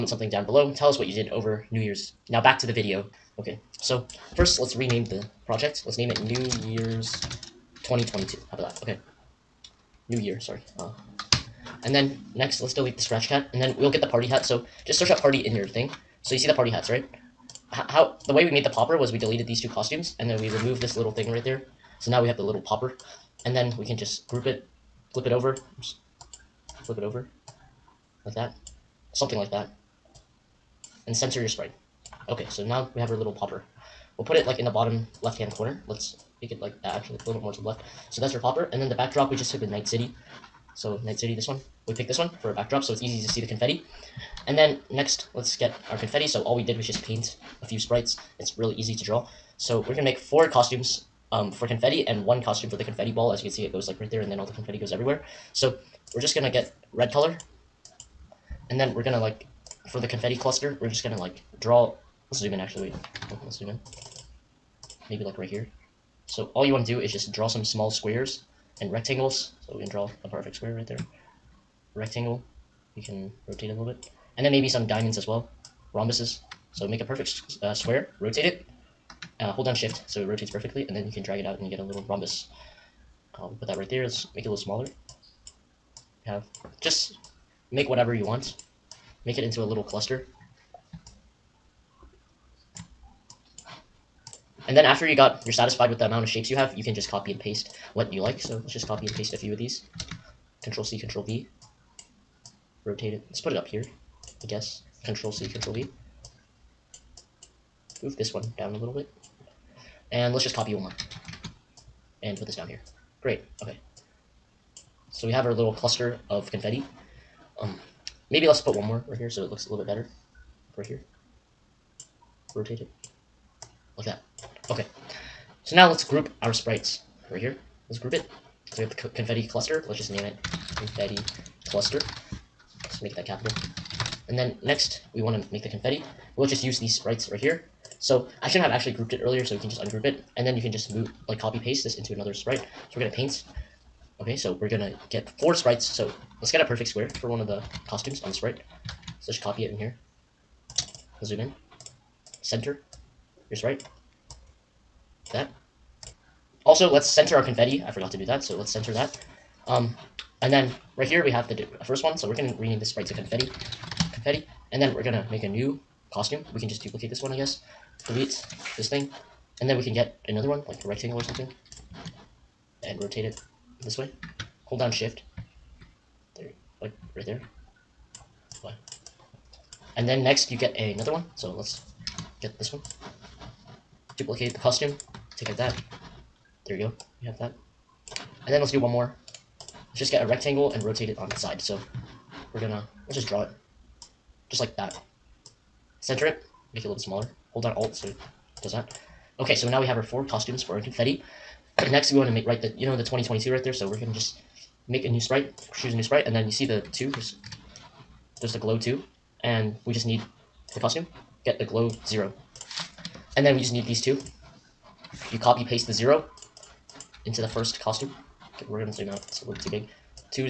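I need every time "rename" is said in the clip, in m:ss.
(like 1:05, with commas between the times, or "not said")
0:04, 2:42.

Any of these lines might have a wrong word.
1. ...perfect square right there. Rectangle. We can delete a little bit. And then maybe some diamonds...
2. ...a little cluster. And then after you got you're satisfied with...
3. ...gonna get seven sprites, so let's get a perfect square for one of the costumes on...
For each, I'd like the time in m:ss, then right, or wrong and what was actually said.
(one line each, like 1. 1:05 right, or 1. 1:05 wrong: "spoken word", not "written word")
1. 1:10 wrong: "rotate", not "delete"
2. 1:29 right
3. 2:24 wrong: "four", not "seven".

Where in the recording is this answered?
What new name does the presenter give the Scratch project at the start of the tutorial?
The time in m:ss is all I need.
0:06.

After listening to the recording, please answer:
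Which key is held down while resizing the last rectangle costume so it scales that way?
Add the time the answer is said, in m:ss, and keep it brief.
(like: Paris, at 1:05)
Alt, at 3:17.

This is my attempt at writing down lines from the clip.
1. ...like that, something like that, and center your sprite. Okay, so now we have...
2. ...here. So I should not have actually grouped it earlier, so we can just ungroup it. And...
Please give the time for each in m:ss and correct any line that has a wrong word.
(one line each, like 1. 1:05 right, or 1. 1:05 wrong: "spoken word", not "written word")
1. 0:28 right
2. 2:17 right.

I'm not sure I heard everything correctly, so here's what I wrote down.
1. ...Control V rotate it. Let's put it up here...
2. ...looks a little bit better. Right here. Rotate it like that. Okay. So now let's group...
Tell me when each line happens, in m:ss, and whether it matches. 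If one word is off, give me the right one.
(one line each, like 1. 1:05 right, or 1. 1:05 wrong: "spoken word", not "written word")
1. 1:40 right
2. 1:59 right.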